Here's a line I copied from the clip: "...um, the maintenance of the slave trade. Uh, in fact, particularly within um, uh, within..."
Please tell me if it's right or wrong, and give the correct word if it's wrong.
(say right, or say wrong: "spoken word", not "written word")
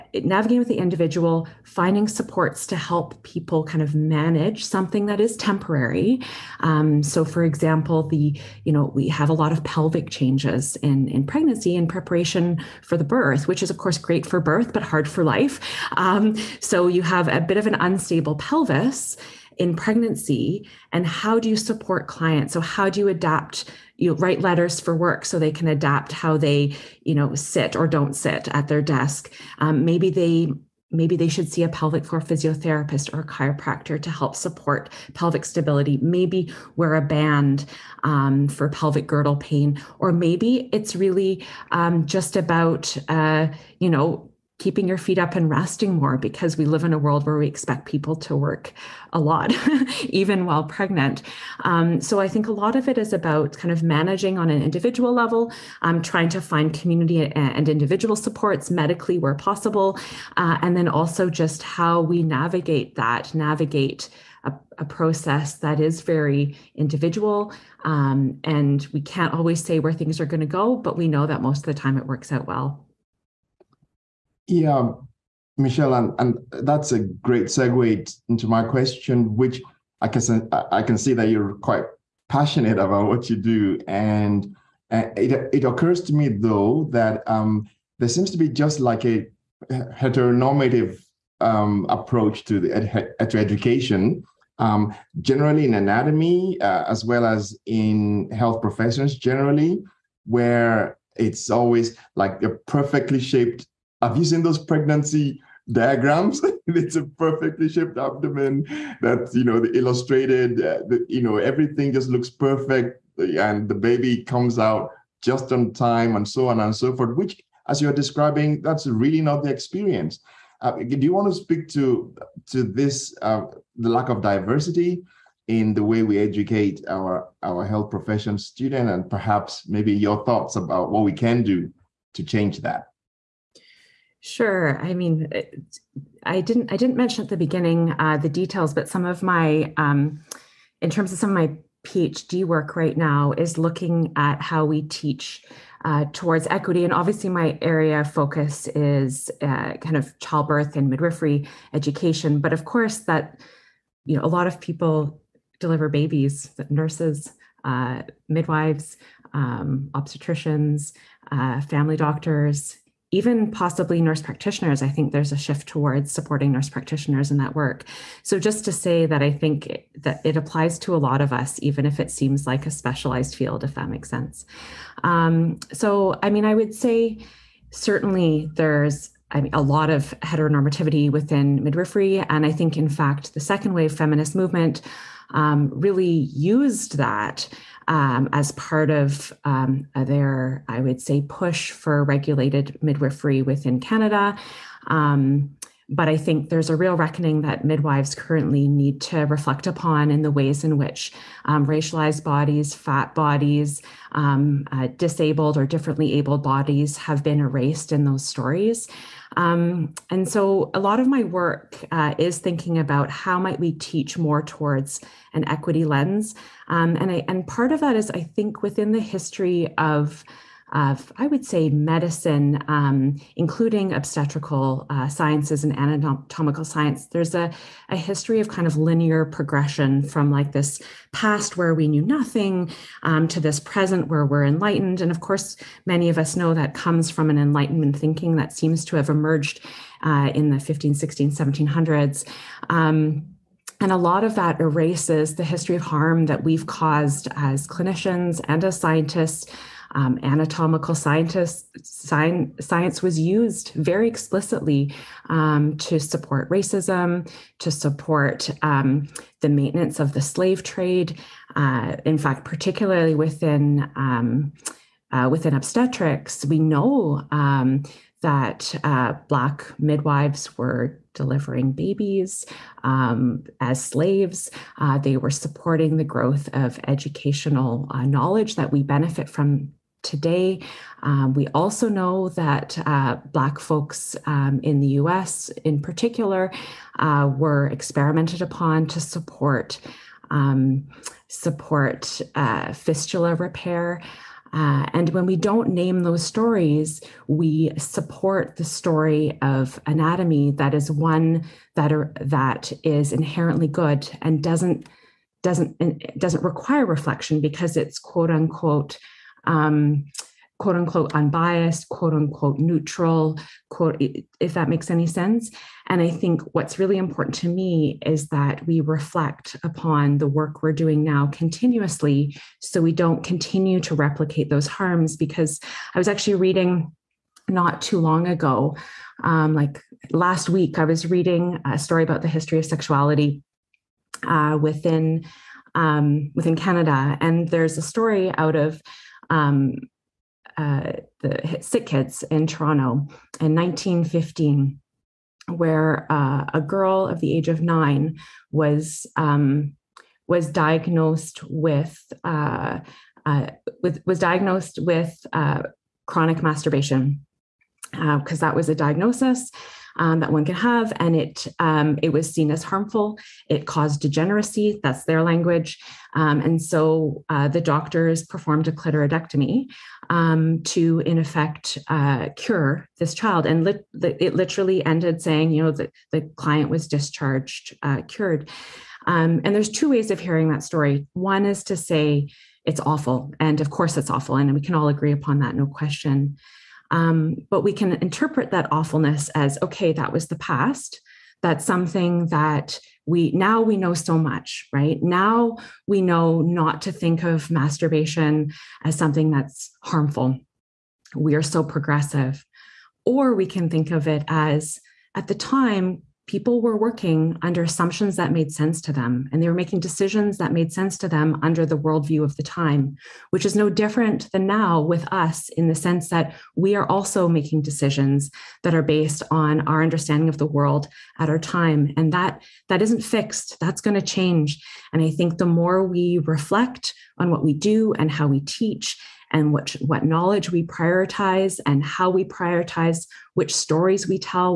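right.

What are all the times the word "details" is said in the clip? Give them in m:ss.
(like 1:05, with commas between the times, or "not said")
2:18.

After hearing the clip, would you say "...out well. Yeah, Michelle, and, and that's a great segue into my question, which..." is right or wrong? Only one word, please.
right.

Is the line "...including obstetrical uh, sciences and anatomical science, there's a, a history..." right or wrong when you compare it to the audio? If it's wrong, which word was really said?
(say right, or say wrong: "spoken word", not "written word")
right.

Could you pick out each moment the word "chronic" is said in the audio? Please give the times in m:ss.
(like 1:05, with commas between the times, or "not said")
5:56.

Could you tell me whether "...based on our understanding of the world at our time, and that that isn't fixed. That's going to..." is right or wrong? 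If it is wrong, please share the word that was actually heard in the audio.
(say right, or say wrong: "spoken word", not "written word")
right.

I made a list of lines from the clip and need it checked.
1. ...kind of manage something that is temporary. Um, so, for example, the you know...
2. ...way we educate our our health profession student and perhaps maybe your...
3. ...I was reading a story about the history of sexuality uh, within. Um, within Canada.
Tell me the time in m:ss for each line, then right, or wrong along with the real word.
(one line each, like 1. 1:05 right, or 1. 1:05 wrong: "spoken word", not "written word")
1. 0:03 right
2. 2:05 right
3. 5:30 right.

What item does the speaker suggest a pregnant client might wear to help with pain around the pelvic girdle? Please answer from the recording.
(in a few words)
A band.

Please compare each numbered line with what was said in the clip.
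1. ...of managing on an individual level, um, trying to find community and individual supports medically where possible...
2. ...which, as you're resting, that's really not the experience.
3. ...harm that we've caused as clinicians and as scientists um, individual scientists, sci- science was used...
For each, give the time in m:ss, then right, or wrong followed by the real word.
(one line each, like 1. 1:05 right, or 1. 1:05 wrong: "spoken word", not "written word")
1. 0:53 right
2. 1:57 wrong: "describing", not "resting"
3. 4:05 wrong: "anatomical", not "individual".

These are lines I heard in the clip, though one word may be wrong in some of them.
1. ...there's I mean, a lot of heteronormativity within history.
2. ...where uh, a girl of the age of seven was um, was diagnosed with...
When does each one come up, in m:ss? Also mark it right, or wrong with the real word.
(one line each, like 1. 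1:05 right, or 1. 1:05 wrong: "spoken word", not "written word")
1. 2:58 wrong: "midwifery", not "history"
2. 5:45 wrong: "nine", not "seven".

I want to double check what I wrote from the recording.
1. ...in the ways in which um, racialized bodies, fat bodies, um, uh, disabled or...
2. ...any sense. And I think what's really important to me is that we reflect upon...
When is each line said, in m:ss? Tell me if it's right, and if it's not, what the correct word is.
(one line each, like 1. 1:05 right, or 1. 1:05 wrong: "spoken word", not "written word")
1. 3:20 right
2. 5:14 right.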